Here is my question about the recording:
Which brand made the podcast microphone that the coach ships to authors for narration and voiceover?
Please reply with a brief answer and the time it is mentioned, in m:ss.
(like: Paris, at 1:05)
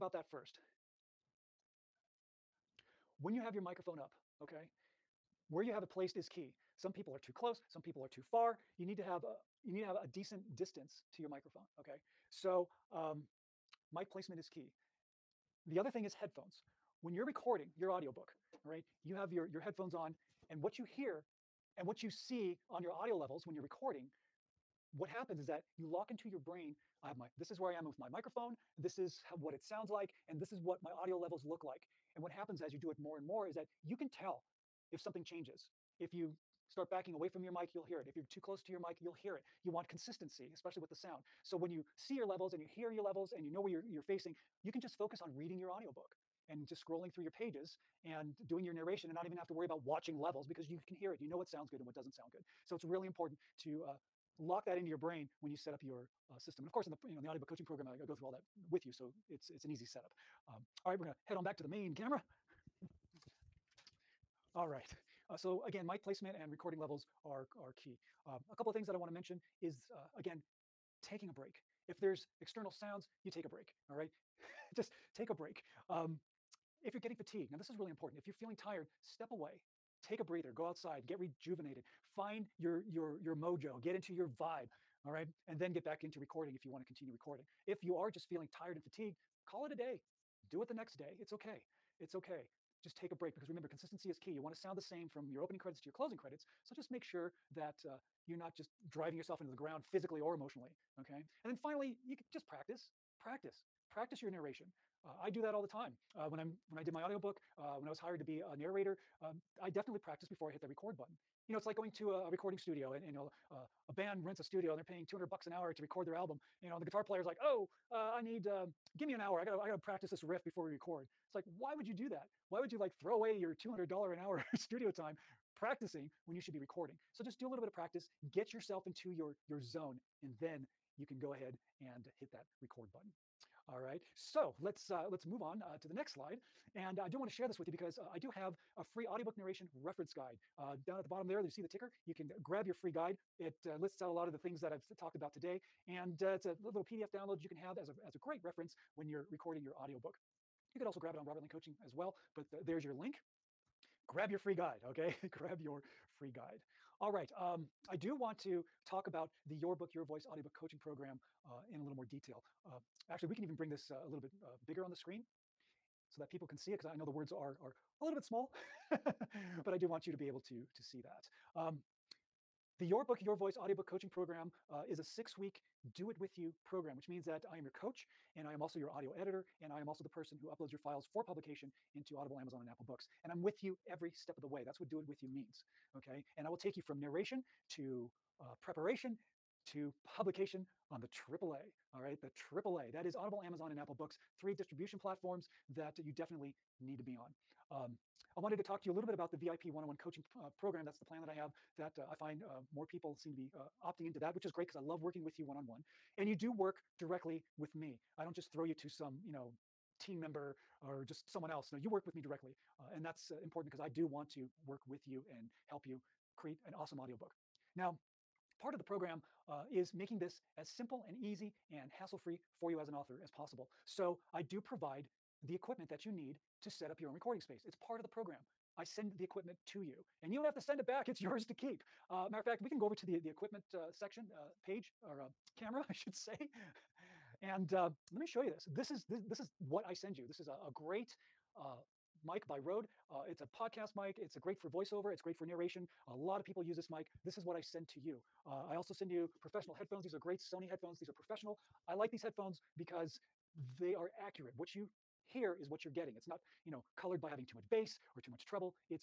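Rode, at 4:02.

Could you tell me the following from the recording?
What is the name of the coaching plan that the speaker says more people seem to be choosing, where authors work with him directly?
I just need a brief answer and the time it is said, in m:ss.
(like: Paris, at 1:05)
VIP one-on-one, at 3:19.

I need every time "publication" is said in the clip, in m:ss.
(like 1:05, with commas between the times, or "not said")
3:01, 3:10.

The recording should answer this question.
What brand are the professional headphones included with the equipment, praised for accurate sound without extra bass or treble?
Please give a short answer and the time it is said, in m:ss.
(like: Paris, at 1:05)
Sony, at 4:10.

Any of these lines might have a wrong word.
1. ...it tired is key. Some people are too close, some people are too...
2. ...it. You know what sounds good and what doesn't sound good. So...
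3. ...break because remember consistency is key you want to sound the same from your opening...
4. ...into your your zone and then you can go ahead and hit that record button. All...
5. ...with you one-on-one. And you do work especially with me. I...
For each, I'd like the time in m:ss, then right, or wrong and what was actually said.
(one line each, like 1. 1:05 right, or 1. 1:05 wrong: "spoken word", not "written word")
1. 0:05 wrong: "placed", not "tired"
2. 0:51 right
3. 1:33 right
4. 2:08 right
5. 3:25 wrong: "directly", not "especially".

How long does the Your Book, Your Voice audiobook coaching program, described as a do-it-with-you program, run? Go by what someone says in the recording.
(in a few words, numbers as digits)
6 weeks.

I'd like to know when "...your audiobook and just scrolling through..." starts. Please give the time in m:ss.
0:45.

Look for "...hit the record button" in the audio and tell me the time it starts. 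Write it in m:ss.
1:50.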